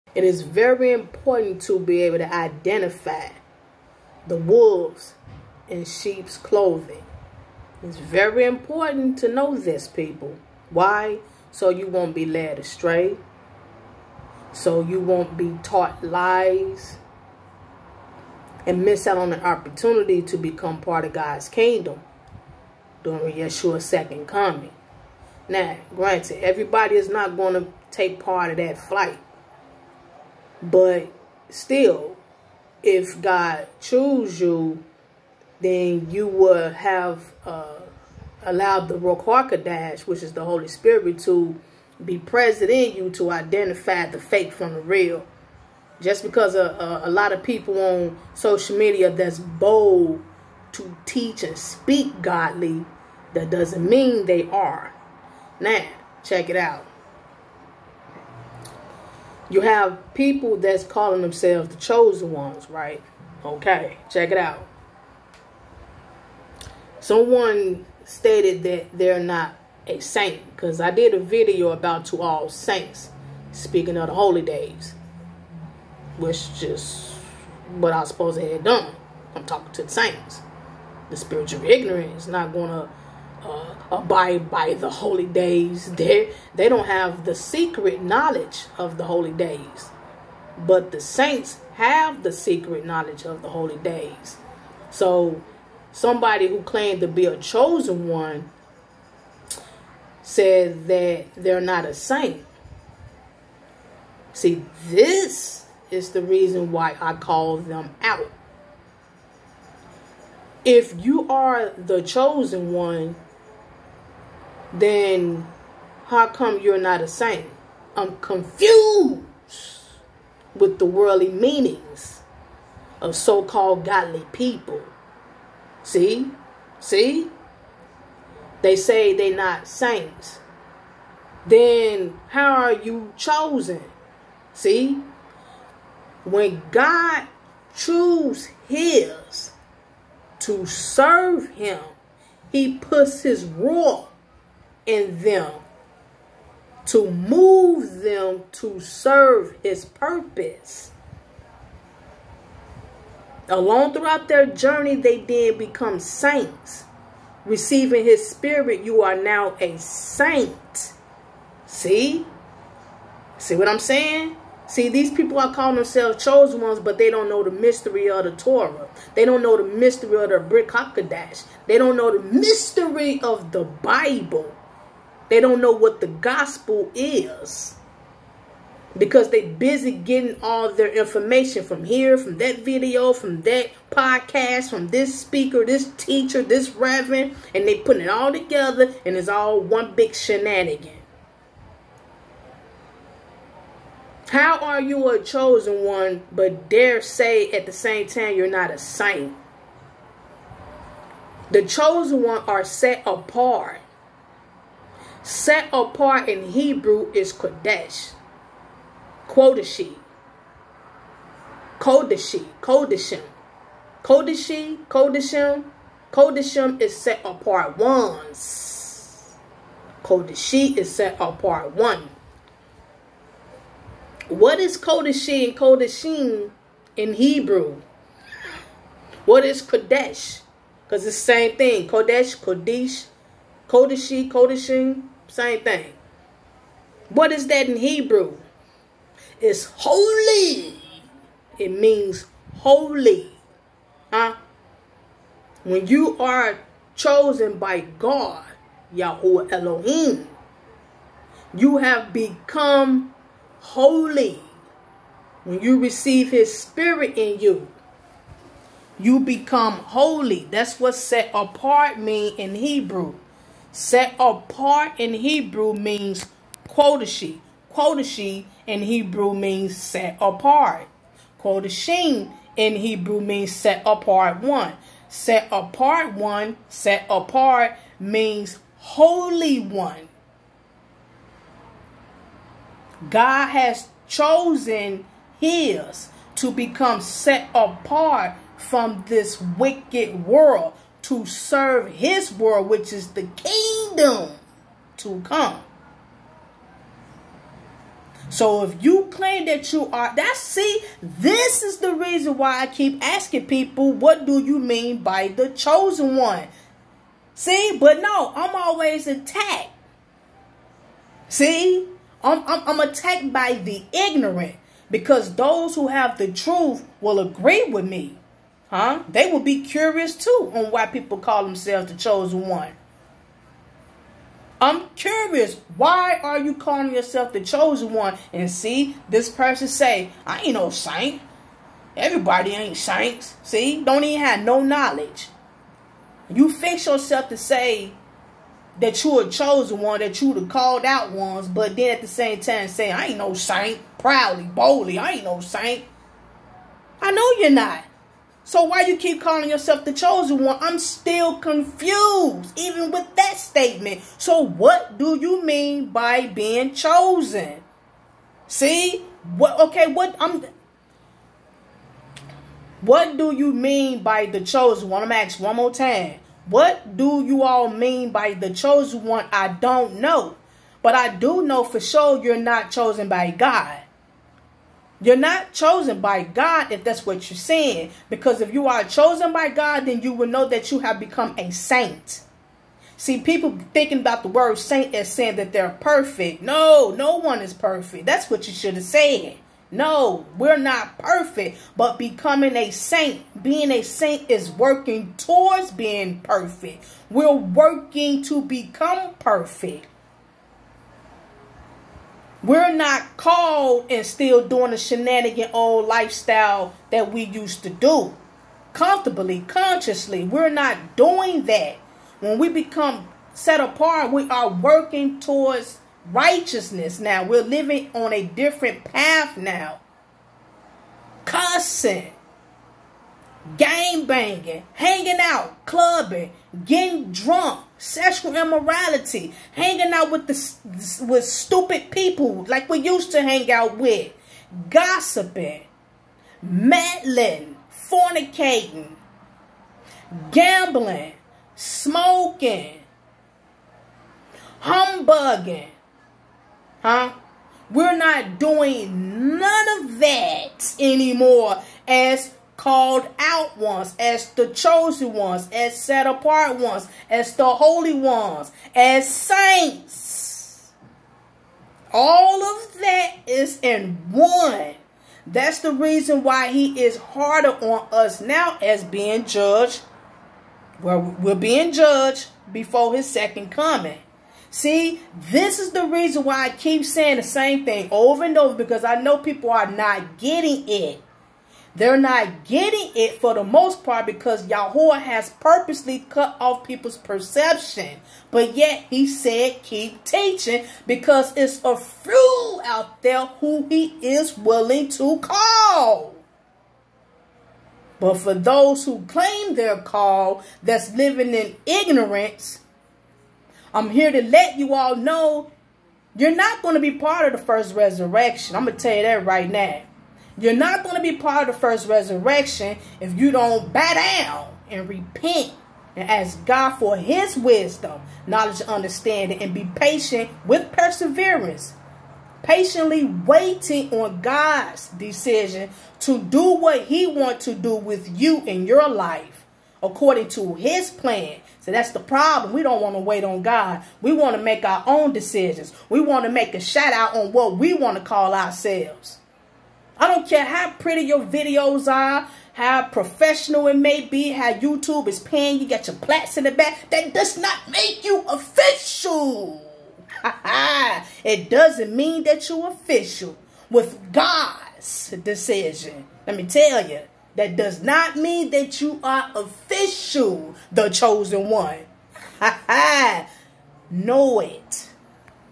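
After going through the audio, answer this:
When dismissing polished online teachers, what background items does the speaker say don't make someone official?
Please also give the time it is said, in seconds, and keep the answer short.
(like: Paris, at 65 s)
Plaques, at 545 s.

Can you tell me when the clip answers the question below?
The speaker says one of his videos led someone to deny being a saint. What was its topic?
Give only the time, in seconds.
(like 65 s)
72 s.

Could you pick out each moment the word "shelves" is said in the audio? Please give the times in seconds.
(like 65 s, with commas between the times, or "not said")
not said.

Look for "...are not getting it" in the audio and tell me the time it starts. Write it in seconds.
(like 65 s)
479 s.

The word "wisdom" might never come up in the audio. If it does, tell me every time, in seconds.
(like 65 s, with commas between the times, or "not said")
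517 s.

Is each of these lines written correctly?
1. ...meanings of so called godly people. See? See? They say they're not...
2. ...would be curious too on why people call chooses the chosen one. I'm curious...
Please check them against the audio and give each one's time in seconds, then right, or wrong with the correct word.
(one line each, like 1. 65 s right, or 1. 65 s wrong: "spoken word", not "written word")
1. 121 s right
2. 319 s wrong: "themselves", not "chooses".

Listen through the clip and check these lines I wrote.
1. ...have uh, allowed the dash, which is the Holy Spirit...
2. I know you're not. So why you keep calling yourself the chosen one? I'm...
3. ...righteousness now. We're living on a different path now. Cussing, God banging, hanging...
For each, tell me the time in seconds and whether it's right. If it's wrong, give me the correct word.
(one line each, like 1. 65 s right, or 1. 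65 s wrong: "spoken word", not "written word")
1. 36 s right
2. 347 s right
3. 416 s wrong: "Game", not "God".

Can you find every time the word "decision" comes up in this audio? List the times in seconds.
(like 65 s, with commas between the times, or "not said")
524 s, 535 s, 555 s.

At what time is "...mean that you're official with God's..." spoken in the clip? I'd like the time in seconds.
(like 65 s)
551 s.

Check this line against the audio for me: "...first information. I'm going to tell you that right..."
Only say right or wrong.
wrong.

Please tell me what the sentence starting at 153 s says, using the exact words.
Along throughout their journey, they then become saints.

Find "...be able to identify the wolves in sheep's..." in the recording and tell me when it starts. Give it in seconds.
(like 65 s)
1 s.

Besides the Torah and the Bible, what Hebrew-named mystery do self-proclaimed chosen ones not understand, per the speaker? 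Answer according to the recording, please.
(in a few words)
Brick Hakodash.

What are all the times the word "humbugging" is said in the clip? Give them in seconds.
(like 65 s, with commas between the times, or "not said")
444 s.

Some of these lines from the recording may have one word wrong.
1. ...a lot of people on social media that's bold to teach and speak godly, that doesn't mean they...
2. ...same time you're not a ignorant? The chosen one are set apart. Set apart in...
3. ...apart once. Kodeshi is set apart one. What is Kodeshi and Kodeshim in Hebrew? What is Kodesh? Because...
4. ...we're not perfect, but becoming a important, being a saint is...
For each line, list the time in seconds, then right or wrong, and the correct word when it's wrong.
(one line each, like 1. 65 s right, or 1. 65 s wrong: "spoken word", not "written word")
1. 47 s right
2. 197 s wrong: "saint", not "ignorant"
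3. 217 s right
4. 390 s wrong: "saint", not "important".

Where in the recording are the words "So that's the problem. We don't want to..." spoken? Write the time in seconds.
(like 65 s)
531 s.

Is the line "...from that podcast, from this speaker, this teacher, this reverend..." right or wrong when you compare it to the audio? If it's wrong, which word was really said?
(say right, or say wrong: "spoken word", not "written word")
right.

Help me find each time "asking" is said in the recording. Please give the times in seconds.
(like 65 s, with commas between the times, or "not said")
303 s, 365 s.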